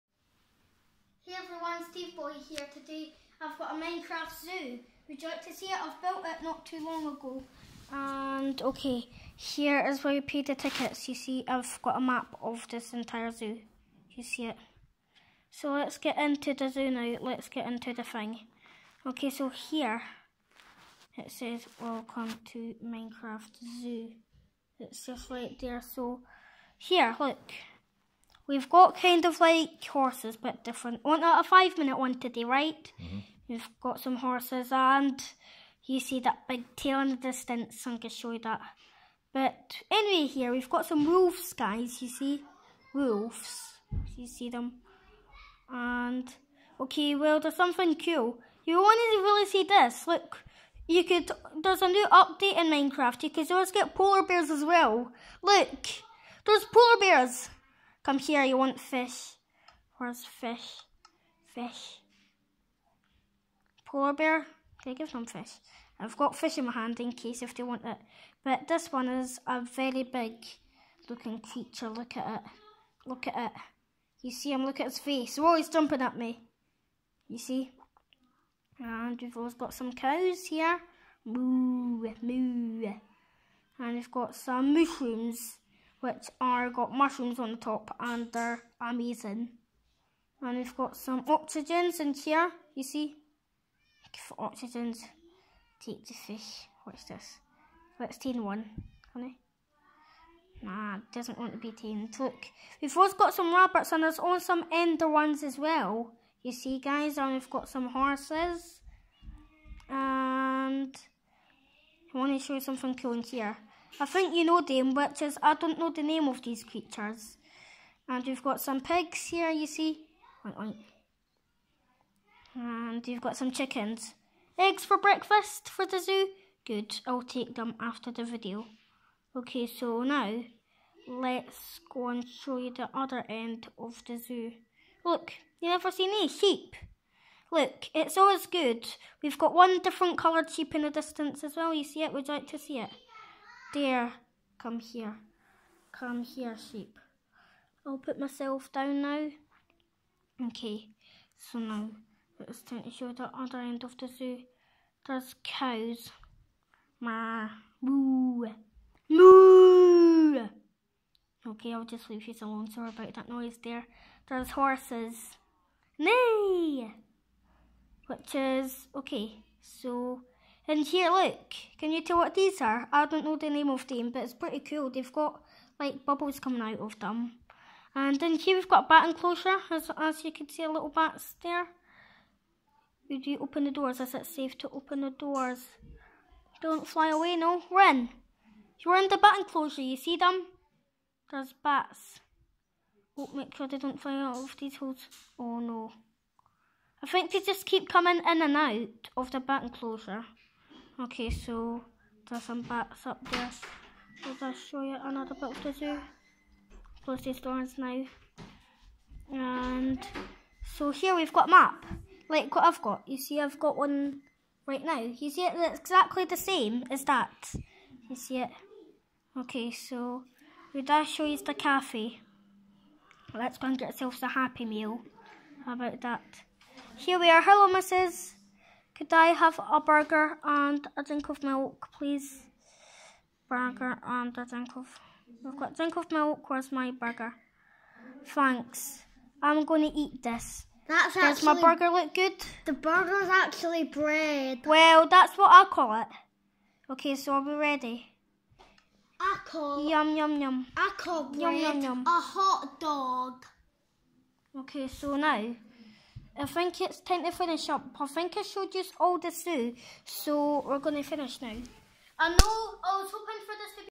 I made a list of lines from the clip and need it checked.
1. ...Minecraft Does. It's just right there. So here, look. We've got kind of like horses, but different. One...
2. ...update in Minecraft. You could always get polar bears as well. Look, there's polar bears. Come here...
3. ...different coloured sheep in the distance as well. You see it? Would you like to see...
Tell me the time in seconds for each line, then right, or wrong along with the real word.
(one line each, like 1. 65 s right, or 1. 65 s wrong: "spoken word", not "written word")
1. 22 s wrong: "Zoo", not "Does"
2. 52 s right
3. 139 s right.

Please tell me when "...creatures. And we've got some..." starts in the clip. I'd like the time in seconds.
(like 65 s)
116 s.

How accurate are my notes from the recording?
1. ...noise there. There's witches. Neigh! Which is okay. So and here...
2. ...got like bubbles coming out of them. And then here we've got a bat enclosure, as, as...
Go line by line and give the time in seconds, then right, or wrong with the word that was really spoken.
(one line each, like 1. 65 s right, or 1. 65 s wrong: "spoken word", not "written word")
1. 163 s wrong: "horses", not "witches"
2. 175 s right.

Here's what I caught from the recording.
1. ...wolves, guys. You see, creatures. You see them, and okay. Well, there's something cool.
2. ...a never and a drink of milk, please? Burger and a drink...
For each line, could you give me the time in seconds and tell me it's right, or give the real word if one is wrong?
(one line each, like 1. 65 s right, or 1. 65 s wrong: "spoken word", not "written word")
1. 41 s wrong: "wolves", not "creatures"
2. 229 s wrong: "burger", not "never".